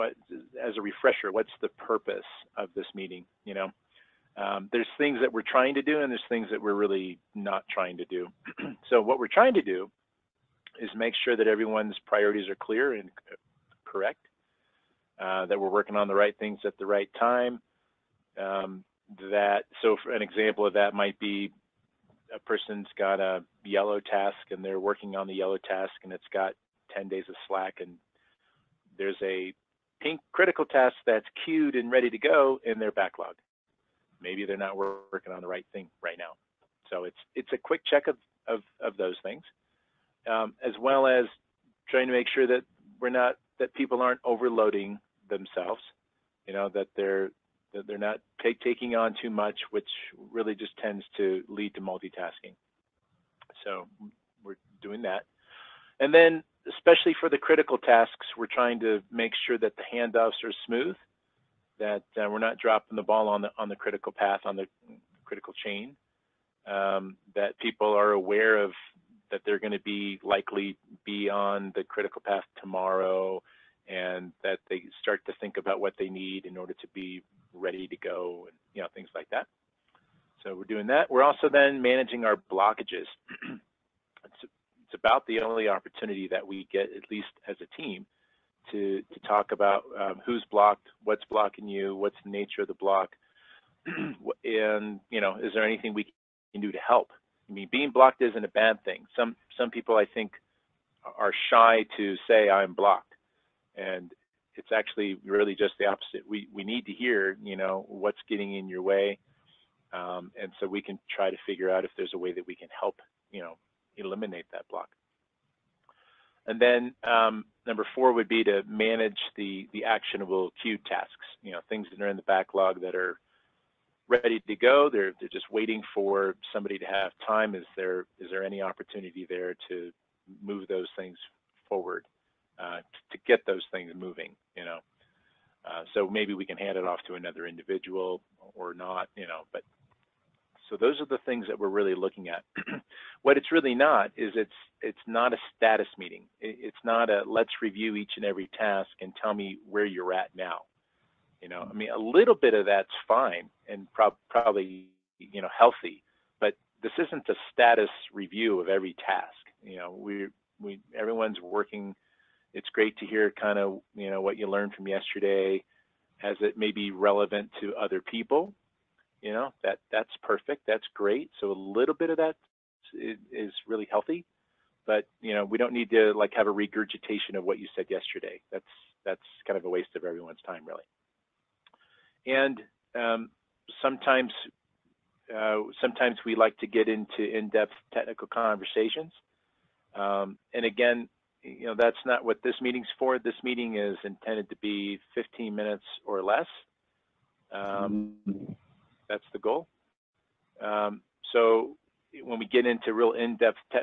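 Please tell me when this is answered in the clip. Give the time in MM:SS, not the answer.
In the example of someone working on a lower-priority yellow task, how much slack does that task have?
00:26.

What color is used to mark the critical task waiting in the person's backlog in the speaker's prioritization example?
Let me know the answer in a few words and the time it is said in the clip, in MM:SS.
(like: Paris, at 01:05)
pink, at 00:30.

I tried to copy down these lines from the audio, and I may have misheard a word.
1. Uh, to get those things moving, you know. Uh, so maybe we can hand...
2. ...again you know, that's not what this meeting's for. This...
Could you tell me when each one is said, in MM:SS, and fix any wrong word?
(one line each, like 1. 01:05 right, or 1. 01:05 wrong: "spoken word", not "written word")
1. 02:12 right
2. 03:10 right.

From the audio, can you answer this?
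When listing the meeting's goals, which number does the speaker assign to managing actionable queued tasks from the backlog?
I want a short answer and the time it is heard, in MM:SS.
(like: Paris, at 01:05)
4, at 01:57.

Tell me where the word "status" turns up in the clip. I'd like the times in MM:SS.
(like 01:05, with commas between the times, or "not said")
02:25, 02:37.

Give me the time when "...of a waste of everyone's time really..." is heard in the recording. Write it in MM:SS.
02:59.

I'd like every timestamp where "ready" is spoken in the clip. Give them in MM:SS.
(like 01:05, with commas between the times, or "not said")
00:31, 01:17, 02:04.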